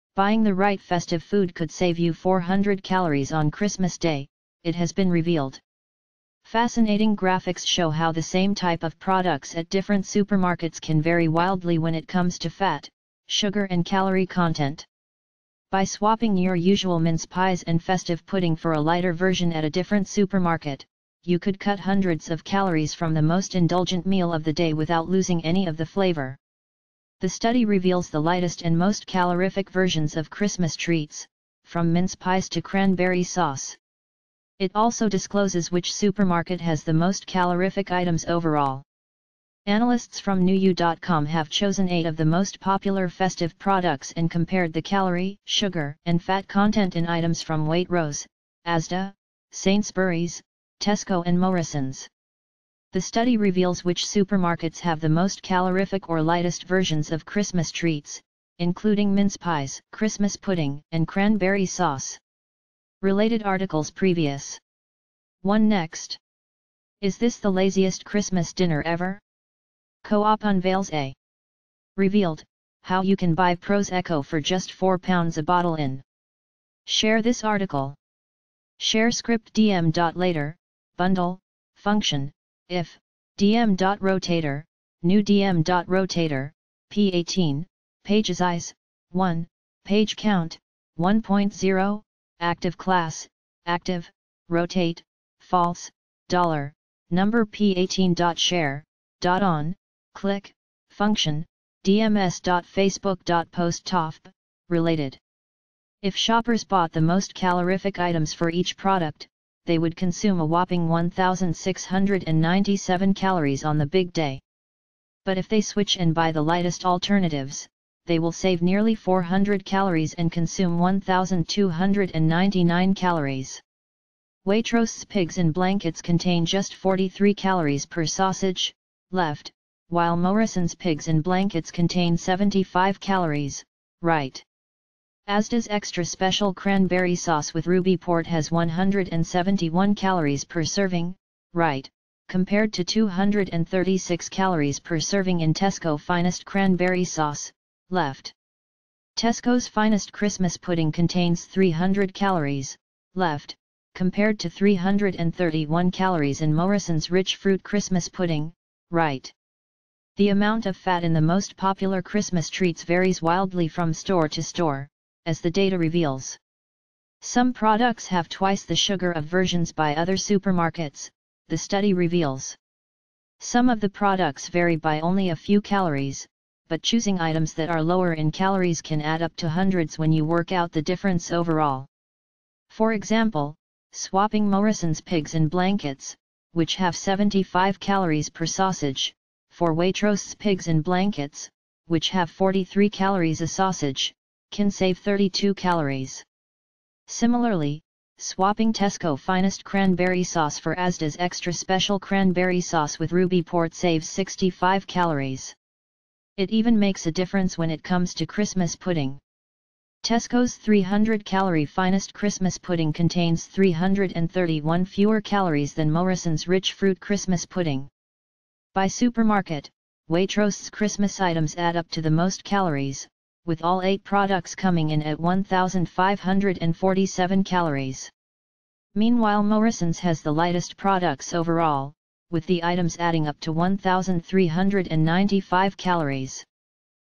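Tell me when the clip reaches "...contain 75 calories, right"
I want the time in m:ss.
2:11.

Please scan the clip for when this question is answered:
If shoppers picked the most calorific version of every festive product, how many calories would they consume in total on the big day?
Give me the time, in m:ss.
1:50.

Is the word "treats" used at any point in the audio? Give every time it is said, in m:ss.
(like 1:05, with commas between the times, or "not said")
0:30, 0:57, 2:42.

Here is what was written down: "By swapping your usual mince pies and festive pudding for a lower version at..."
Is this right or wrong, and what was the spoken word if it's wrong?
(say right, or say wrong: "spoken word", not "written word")
wrong: "lighter", not "lower".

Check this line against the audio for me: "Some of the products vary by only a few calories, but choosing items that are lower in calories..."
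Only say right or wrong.
right.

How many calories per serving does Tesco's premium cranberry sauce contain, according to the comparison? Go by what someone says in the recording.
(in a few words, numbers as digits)
236.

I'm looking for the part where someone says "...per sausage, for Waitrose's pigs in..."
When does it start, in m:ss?
3:08.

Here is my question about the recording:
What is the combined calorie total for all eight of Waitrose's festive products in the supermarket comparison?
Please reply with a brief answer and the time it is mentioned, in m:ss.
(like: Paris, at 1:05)
1,547, at 3:45.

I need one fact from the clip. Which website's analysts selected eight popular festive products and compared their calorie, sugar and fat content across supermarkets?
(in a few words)
Newy.com.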